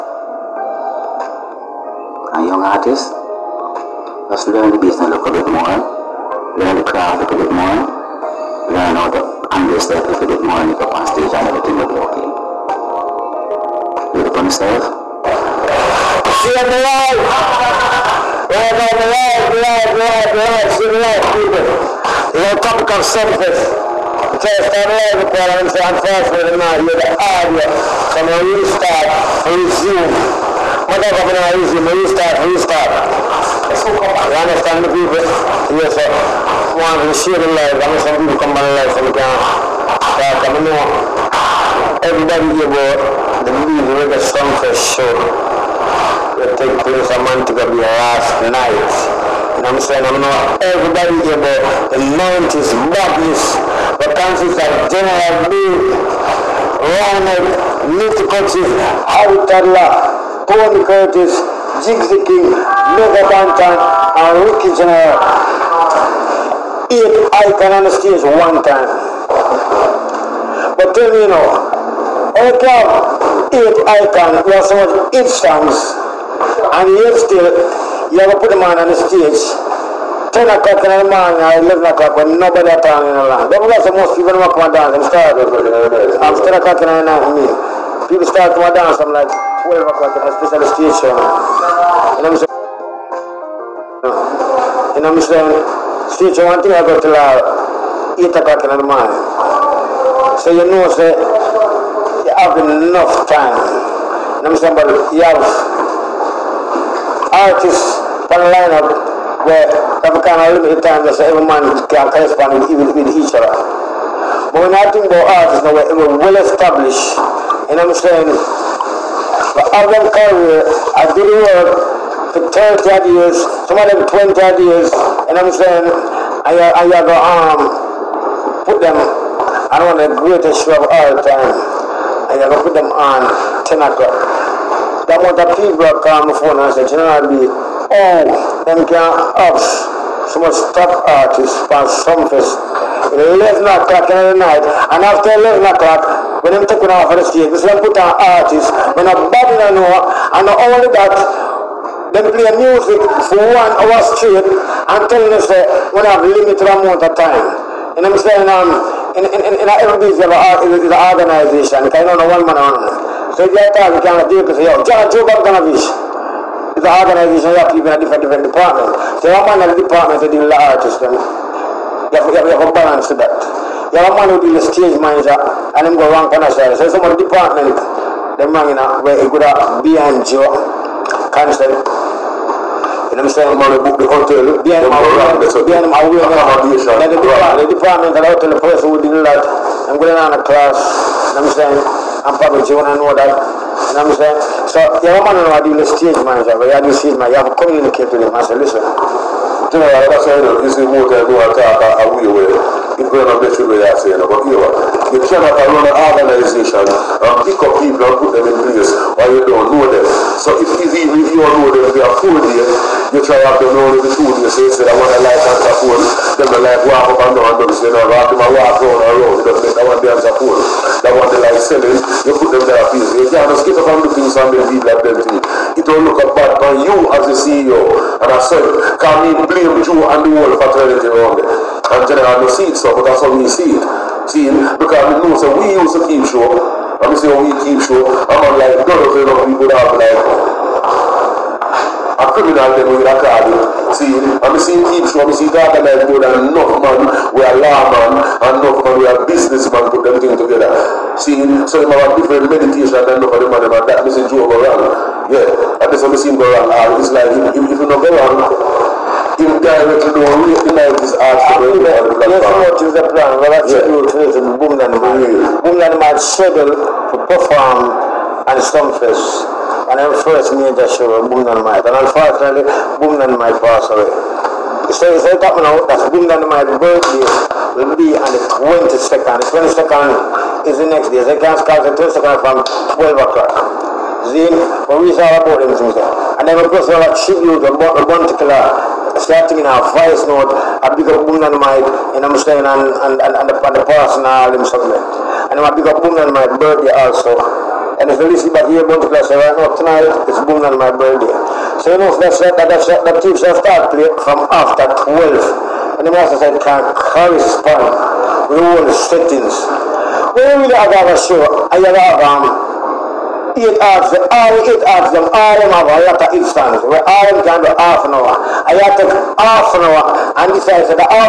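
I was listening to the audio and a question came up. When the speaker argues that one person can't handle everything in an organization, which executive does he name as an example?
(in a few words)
Joe Bogdanovich.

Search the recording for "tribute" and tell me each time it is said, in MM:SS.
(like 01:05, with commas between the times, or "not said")
04:47.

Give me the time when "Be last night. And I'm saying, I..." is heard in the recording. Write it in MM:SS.
00:47.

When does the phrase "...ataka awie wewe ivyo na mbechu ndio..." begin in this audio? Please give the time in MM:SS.
03:21.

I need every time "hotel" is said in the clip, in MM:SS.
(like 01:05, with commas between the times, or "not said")
03:04, 03:08.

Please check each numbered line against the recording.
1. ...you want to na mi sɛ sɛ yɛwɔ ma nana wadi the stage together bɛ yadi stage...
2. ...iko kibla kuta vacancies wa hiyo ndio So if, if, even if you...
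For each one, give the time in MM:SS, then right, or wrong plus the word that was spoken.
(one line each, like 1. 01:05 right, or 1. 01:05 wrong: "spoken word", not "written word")
1. 03:12 wrong: "manager", not "together"
2. 03:27 wrong: "mbiyes", not "vacancies".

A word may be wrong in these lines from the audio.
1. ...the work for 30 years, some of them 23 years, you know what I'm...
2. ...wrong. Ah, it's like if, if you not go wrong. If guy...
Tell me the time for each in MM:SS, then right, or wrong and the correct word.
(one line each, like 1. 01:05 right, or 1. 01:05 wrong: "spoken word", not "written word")
1. 02:01 wrong: "20", not "23"
2. 04:16 right.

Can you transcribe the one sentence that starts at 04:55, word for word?
And I big up Boom my birthday also.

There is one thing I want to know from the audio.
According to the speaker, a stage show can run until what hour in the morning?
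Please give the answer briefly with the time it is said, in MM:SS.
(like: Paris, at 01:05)
8 o'clock, at 01:38.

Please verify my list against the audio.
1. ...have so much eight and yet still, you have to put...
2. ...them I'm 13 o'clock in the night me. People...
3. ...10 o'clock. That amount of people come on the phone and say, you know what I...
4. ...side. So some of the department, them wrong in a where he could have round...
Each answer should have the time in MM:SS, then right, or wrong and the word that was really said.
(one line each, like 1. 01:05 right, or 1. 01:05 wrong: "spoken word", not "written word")
1. 01:14 right
2. 01:25 wrong: "10", not "13"
3. 02:13 right
4. 02:56 wrong: "behind", not "round".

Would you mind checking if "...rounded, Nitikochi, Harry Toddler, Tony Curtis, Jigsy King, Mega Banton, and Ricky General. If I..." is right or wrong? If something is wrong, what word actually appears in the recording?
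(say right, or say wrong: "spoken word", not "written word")
right.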